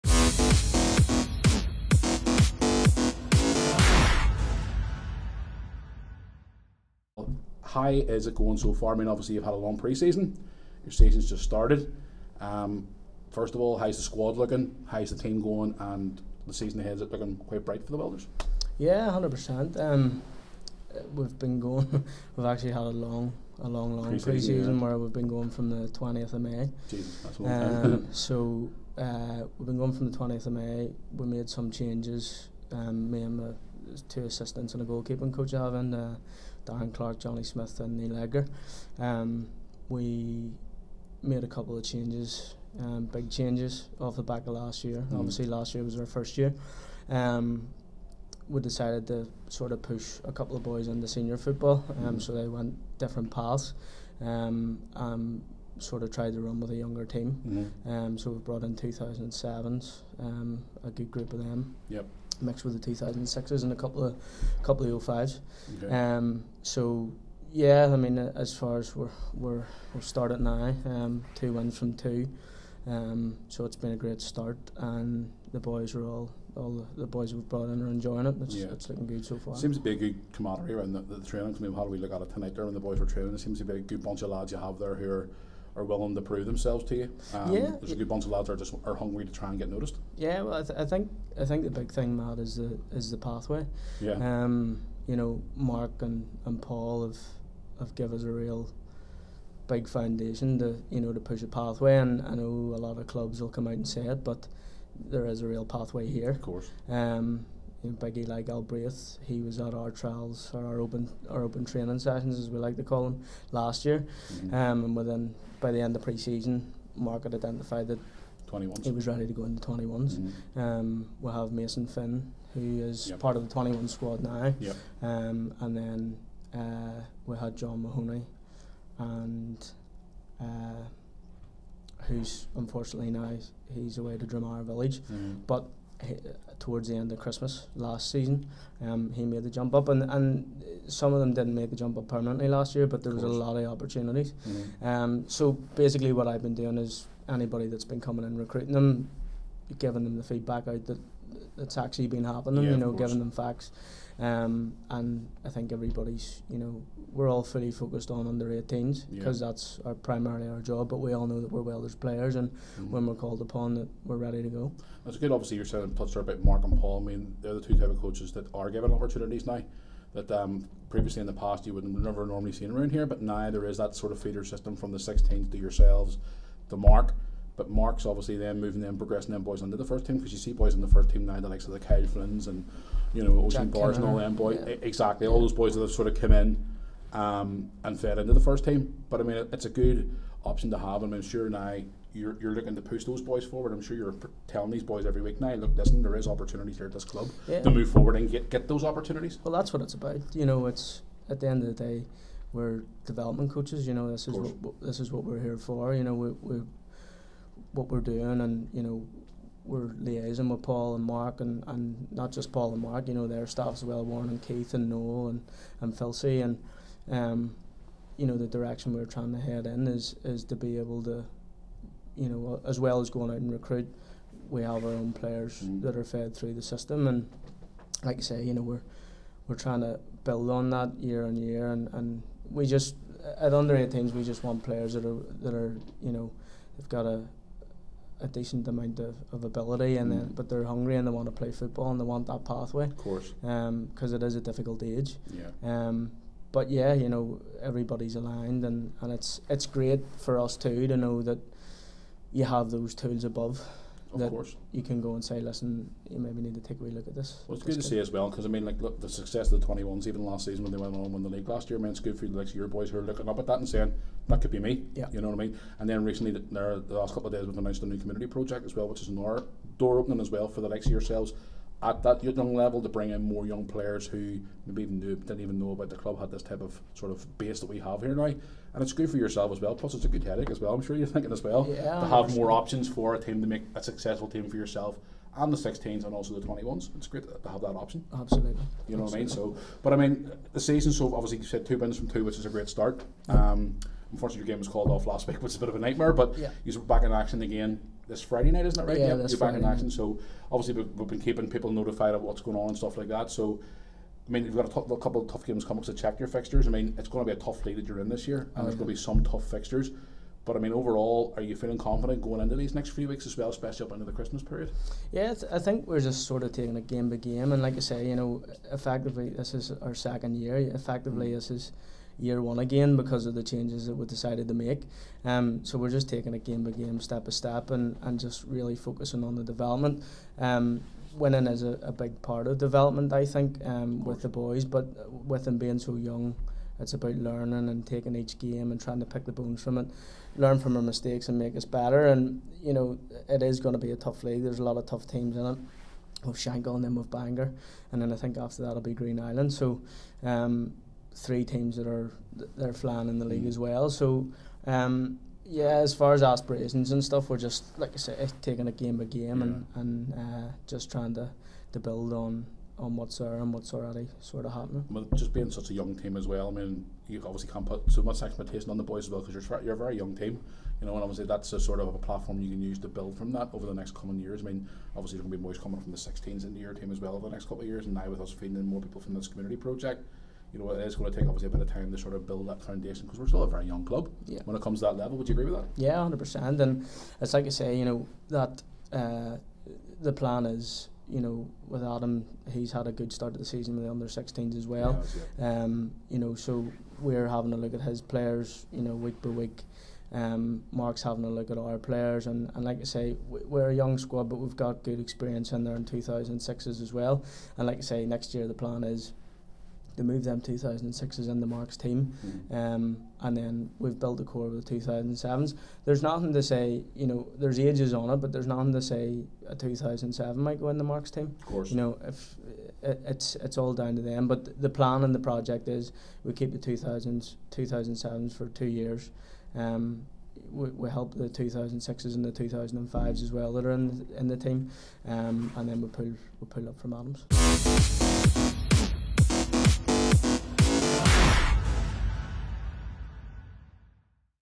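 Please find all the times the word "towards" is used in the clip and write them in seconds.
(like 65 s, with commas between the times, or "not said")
136 s.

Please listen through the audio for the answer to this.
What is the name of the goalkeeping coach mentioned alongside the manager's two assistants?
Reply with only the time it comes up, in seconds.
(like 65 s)
37 s.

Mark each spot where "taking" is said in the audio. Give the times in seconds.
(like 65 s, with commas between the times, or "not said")
316 s, 326 s, 337 s, 358 s.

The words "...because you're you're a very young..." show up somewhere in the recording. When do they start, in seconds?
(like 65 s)
369 s.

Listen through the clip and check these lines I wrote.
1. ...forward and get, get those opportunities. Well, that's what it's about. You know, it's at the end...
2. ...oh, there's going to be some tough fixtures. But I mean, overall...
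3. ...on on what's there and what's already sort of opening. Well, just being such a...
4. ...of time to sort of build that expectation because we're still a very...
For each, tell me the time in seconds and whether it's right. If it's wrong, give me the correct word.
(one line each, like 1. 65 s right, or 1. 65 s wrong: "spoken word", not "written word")
1. 197 s right
2. 308 s right
3. 362 s wrong: "happening", not "opening"
4. 381 s wrong: "foundation", not "expectation".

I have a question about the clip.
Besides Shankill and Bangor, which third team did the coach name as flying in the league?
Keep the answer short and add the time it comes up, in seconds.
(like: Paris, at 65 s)
Green Island, at 348 s.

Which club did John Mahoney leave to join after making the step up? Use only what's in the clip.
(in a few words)
Drumar Village.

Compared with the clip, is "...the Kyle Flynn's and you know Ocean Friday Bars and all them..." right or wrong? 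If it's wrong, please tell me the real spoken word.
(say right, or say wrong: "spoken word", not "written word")
wrong: "Jack", not "Friday".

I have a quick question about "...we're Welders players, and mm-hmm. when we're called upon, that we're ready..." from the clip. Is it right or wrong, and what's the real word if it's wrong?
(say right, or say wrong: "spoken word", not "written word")
right.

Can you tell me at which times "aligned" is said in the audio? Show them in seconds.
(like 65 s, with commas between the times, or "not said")
248 s.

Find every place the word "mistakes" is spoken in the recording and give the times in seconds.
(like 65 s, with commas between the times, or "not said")
340 s.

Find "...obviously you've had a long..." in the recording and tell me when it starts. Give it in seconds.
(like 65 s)
9 s.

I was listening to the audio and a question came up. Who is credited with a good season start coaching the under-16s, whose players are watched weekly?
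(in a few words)
Adam.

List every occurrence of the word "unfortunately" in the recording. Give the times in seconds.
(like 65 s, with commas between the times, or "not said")
132 s, 294 s.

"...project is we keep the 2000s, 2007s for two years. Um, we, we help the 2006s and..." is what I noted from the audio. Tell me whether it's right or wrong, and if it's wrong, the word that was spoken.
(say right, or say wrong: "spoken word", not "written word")
right.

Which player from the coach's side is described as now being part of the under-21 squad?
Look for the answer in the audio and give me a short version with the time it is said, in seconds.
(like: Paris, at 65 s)
Mason Finn, at 121 s.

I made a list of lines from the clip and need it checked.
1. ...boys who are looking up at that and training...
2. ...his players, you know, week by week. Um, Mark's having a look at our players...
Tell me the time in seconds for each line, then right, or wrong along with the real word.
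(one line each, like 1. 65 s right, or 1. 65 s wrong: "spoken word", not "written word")
1. 262 s wrong: "saying", not "training"
2. 397 s right.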